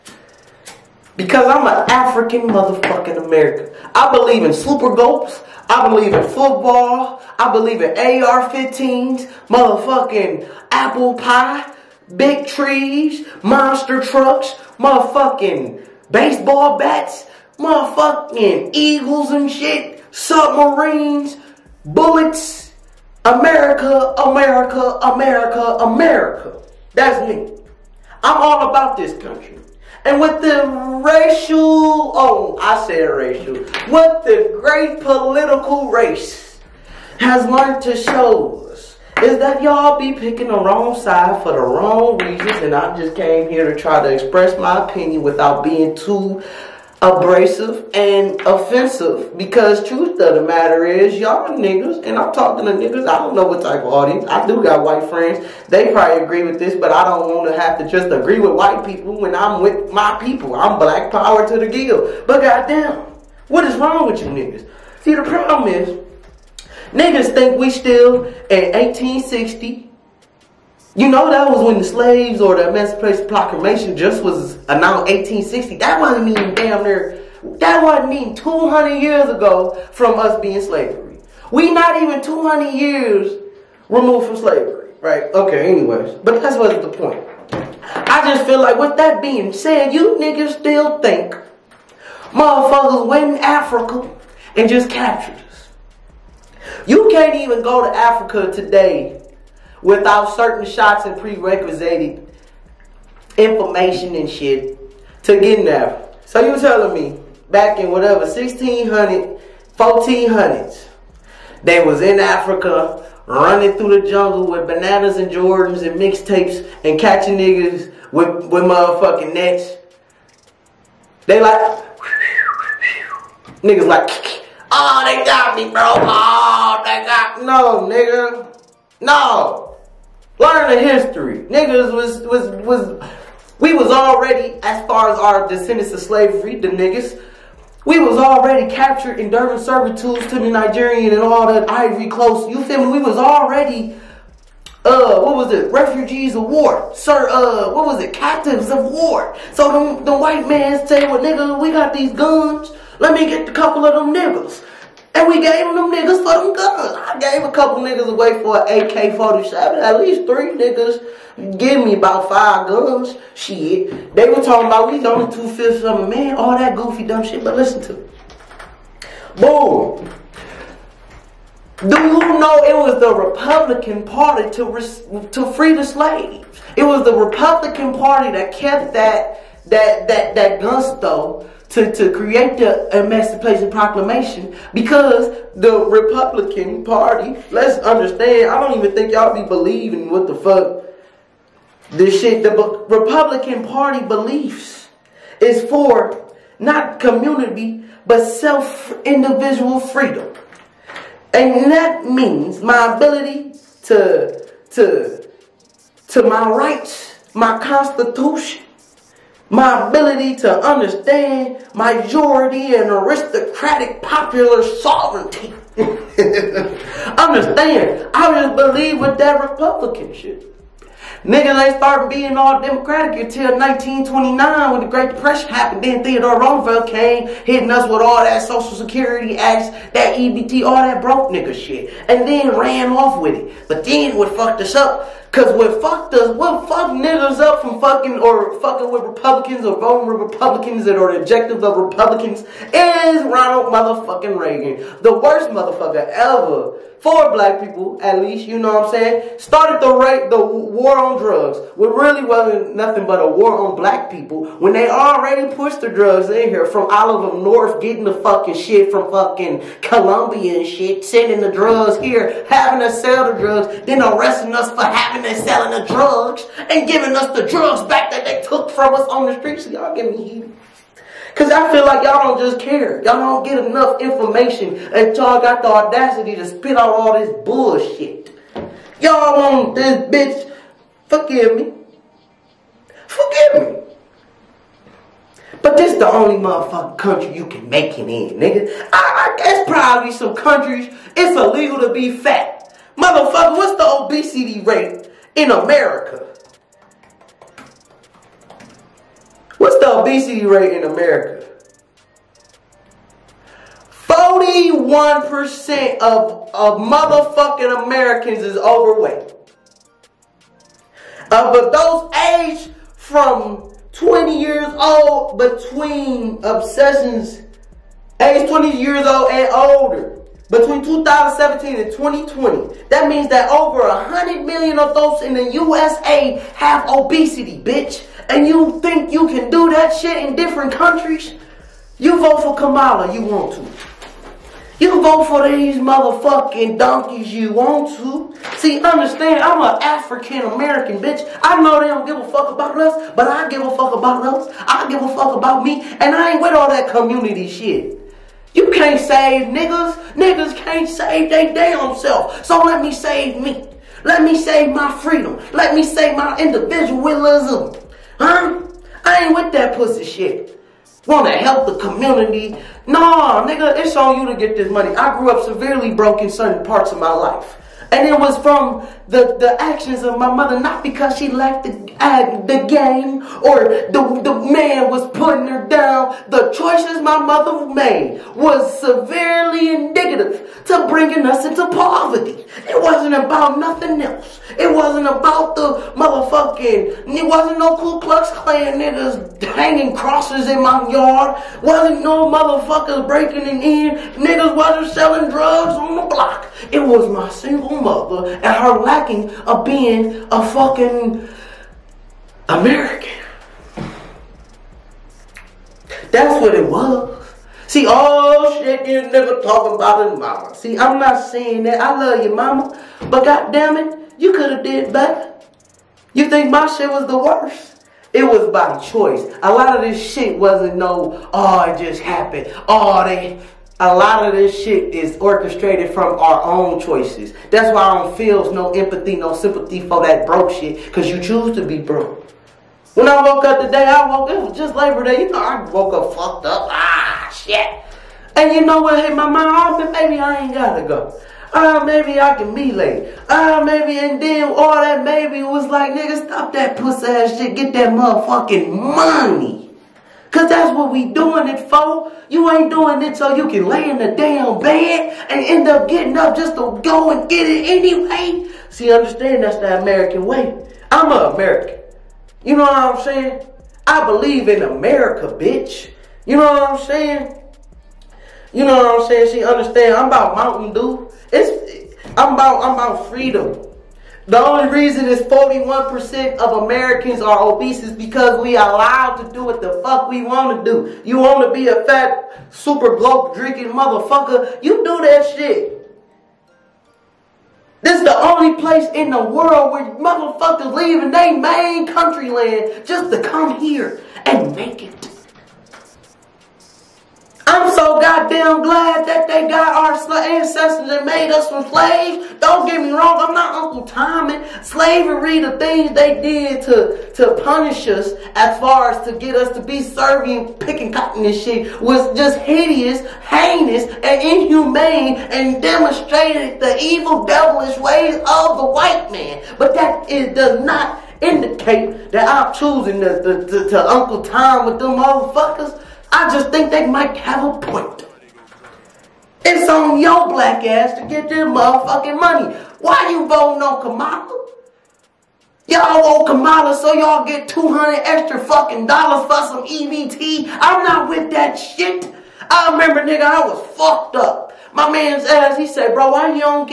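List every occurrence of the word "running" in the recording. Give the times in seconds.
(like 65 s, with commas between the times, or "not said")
113 s.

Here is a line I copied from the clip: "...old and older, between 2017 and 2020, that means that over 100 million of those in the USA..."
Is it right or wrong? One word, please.
right.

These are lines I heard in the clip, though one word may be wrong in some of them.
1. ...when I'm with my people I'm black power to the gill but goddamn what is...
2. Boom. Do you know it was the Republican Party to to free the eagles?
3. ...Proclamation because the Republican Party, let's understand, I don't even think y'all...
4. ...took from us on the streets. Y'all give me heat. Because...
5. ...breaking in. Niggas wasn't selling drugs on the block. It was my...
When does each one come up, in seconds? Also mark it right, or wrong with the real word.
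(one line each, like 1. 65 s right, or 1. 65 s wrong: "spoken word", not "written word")
1. 59 s right
2. 169 s wrong: "slaves", not "eagles"
3. 183 s right
4. 268 s right
5. 393 s right.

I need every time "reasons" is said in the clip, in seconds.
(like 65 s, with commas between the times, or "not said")
42 s, 474 s.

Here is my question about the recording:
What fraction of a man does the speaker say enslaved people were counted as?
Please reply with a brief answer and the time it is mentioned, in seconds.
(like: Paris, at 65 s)
two-fifths, at 165 s.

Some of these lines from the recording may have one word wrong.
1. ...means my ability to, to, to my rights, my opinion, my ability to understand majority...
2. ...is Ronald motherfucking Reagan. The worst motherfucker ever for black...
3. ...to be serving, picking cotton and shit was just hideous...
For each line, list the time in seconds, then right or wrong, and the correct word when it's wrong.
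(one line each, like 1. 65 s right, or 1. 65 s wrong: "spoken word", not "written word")
1. 202 s wrong: "constitution", not "opinion"
2. 242 s right
3. 509 s right.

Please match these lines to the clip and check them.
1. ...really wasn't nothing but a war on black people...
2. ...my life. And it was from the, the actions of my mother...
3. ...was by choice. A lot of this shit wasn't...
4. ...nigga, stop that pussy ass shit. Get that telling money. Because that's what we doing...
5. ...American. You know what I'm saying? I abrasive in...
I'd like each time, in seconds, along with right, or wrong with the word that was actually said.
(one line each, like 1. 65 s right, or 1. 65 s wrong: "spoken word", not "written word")
1. 251 s right
2. 366 s right
3. 418 s right
4. 445 s wrong: "motherfucking", not "telling"
5. 461 s wrong: "believe", not "abrasive".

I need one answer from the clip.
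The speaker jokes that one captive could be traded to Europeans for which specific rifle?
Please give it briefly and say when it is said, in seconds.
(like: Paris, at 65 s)
AK-47, at 158 s.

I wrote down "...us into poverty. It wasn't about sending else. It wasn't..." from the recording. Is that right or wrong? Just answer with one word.
wrong.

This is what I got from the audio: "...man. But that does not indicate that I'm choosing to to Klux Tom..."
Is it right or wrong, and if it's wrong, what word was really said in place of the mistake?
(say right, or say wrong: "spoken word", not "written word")
wrong: "Uncle", not "Klux".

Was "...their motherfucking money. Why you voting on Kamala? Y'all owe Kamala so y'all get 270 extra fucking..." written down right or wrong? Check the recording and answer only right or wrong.
wrong.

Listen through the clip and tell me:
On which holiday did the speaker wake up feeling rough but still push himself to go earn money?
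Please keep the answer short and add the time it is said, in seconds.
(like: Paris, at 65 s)
Labor Day, at 434 s.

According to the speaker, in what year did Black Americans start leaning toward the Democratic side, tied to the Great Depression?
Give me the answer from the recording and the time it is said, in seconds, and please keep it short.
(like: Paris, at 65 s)
1929, at 223 s.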